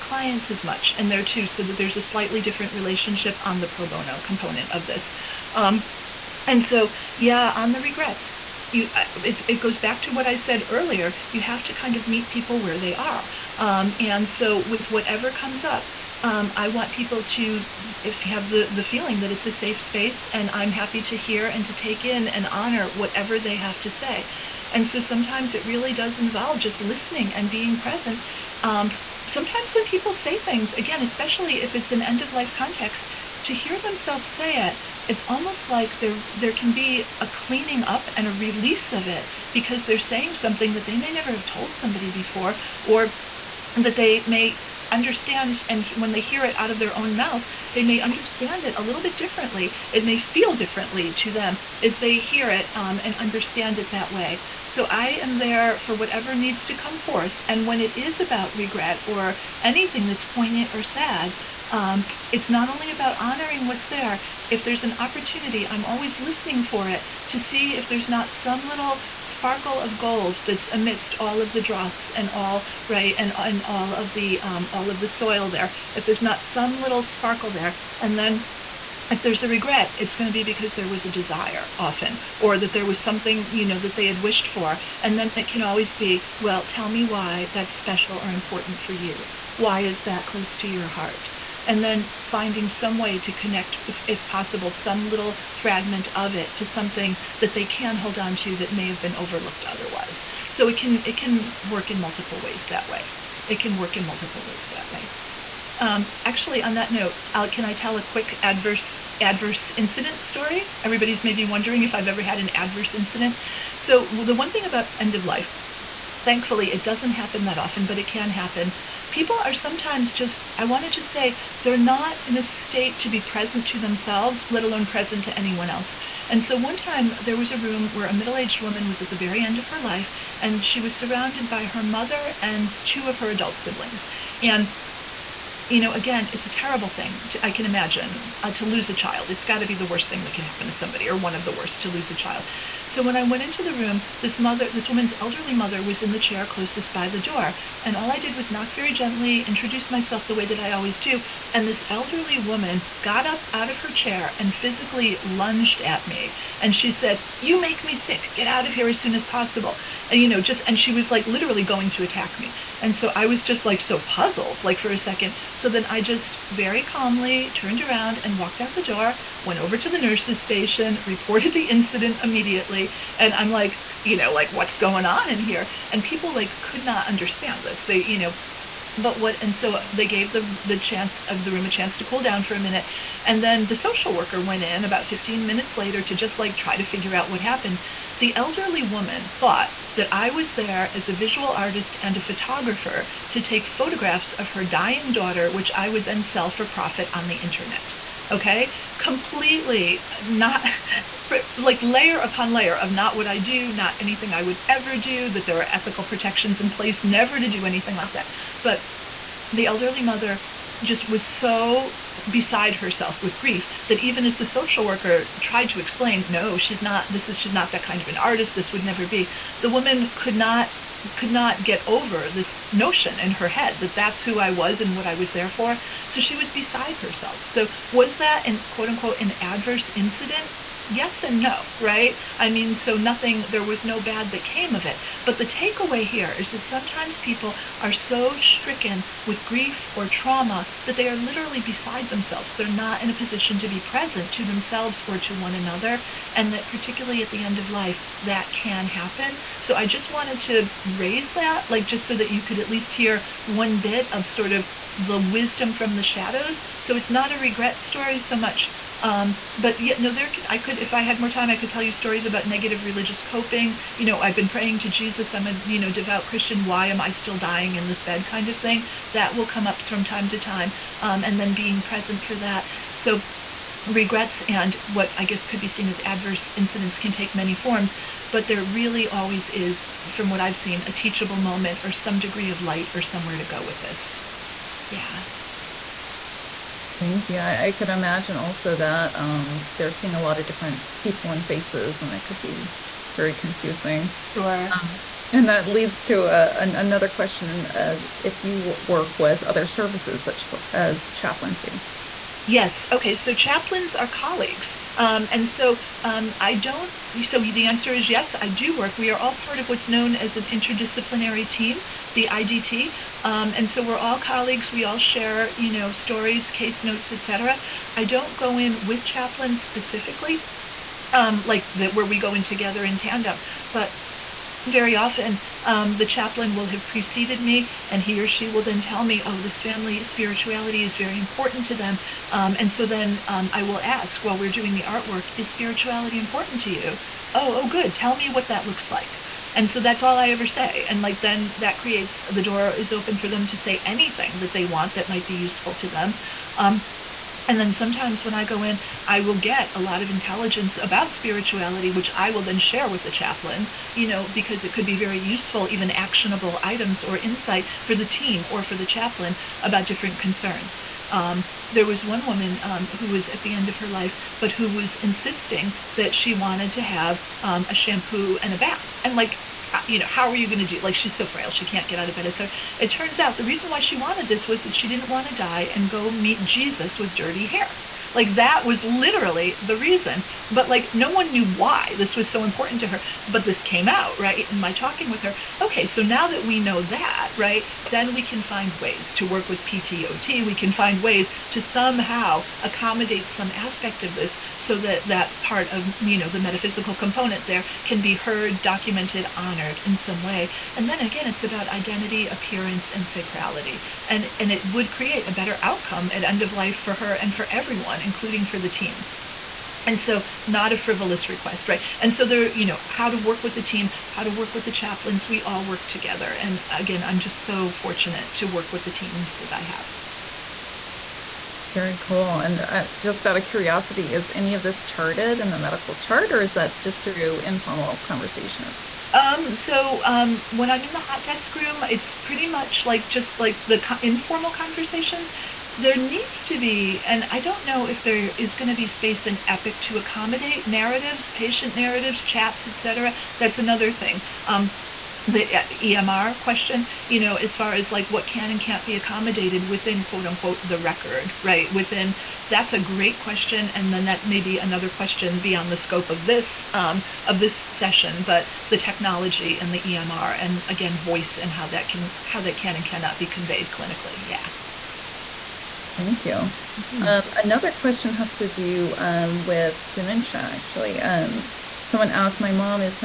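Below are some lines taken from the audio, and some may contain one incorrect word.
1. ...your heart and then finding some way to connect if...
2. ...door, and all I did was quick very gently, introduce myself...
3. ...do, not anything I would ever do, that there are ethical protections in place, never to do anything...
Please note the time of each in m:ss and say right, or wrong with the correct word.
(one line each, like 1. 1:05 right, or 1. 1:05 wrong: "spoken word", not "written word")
1. 1:30 right
2. 2:27 wrong: "knock", not "quick"
3. 3:23 right.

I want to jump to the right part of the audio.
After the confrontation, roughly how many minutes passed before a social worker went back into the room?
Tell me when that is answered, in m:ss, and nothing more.
3:05.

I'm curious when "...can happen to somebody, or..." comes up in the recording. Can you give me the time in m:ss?
2:20.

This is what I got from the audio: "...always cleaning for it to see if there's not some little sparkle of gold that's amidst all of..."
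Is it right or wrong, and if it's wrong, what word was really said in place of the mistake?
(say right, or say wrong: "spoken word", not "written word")
wrong: "listening", not "cleaning".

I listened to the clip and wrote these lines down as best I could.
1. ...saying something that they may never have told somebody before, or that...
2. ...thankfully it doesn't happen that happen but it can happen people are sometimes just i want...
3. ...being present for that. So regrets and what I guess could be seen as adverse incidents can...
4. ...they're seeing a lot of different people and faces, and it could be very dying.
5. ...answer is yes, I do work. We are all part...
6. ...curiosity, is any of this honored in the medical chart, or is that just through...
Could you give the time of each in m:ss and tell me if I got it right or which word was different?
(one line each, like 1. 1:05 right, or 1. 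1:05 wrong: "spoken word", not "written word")
1. 0:39 right
2. 1:56 wrong: "often", not "happen"
3. 4:31 right
4. 4:49 wrong: "confusing", not "dying"
5. 5:07 right
6. 7:03 wrong: "charted", not "honored".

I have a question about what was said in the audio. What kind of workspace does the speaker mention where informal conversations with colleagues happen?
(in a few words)
Hot desk room.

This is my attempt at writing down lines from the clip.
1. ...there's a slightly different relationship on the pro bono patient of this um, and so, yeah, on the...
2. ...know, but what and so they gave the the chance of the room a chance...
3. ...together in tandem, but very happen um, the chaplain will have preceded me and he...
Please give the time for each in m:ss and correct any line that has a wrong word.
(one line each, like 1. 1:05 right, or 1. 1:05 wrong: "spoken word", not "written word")
1. 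0:01 wrong: "component", not "patient"
2. 2:58 right
3. 5:22 wrong: "often", not "happen".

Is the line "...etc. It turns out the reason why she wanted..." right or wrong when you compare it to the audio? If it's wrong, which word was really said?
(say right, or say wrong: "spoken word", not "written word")
right.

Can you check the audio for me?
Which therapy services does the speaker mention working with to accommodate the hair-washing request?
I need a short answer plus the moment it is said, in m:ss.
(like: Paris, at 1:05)
PT/OT, at 6:29.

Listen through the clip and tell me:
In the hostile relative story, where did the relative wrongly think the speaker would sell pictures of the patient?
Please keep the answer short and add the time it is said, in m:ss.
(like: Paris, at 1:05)
On the internet, at 3:17.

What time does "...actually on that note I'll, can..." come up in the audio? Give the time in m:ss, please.
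1:46.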